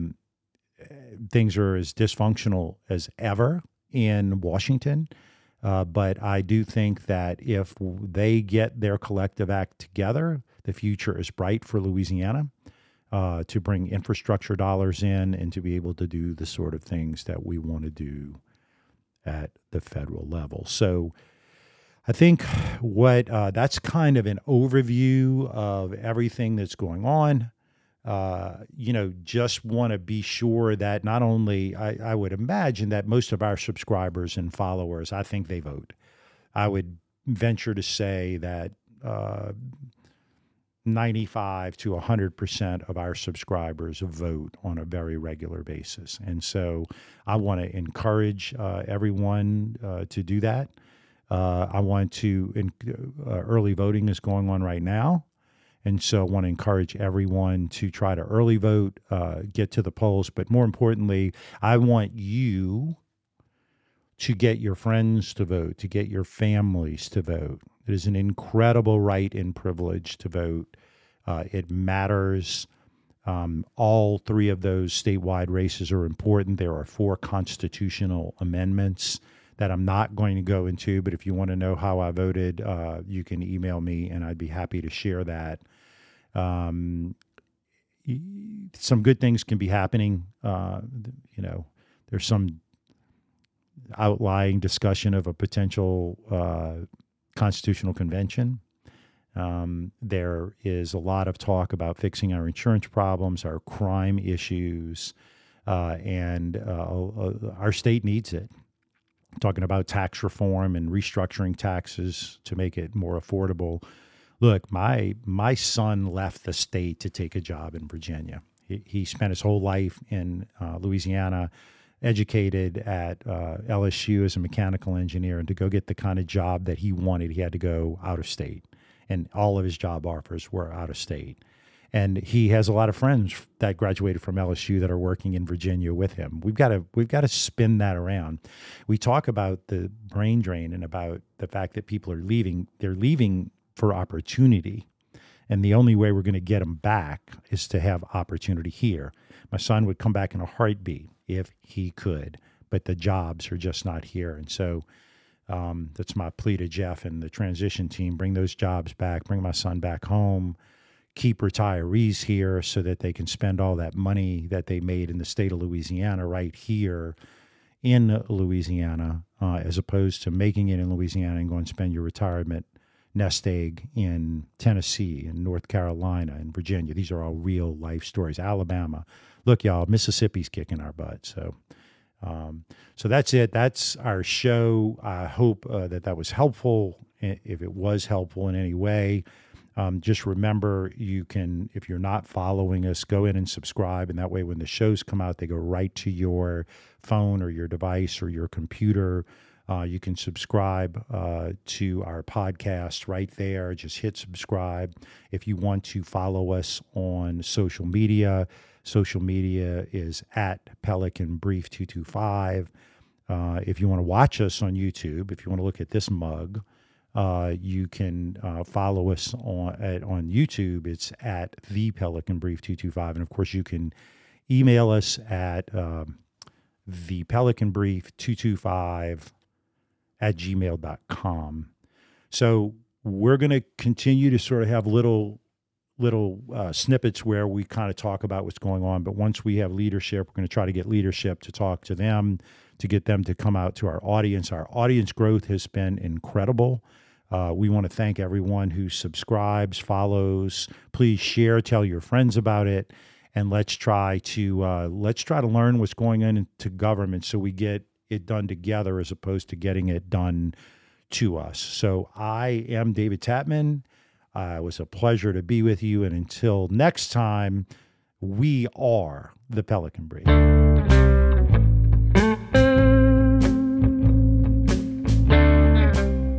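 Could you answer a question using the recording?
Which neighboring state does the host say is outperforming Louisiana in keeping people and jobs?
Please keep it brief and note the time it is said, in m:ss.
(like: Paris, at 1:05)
Mississippi, at 2:59.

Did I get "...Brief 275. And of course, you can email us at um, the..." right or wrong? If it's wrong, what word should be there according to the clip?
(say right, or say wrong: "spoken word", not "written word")
wrong: "225", not "275".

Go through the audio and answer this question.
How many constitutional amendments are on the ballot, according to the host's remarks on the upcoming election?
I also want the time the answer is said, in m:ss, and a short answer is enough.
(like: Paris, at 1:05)
4, at 1:16.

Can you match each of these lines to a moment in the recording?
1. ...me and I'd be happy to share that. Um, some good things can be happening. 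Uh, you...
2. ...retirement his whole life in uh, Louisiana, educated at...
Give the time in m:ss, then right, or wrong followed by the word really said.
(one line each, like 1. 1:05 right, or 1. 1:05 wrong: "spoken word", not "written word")
1. 1:23 right
2. 1:59 wrong: "spent", not "retirement".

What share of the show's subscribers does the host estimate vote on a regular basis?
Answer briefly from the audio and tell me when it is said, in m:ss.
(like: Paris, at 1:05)
95 to 100%, at 0:40.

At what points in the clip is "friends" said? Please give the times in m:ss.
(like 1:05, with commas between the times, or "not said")
1:04, 2:12, 4:11.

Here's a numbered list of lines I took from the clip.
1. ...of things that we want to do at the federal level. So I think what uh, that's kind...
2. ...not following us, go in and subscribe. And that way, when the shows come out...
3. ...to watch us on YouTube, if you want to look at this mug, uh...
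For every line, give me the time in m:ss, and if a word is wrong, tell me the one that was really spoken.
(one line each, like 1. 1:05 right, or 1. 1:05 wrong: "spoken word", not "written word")
1. 0:16 right
2. 3:11 right
3. 3:33 right.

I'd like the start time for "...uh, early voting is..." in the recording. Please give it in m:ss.
0:53.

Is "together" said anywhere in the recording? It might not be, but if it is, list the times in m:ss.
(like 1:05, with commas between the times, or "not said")
0:09, 4:18.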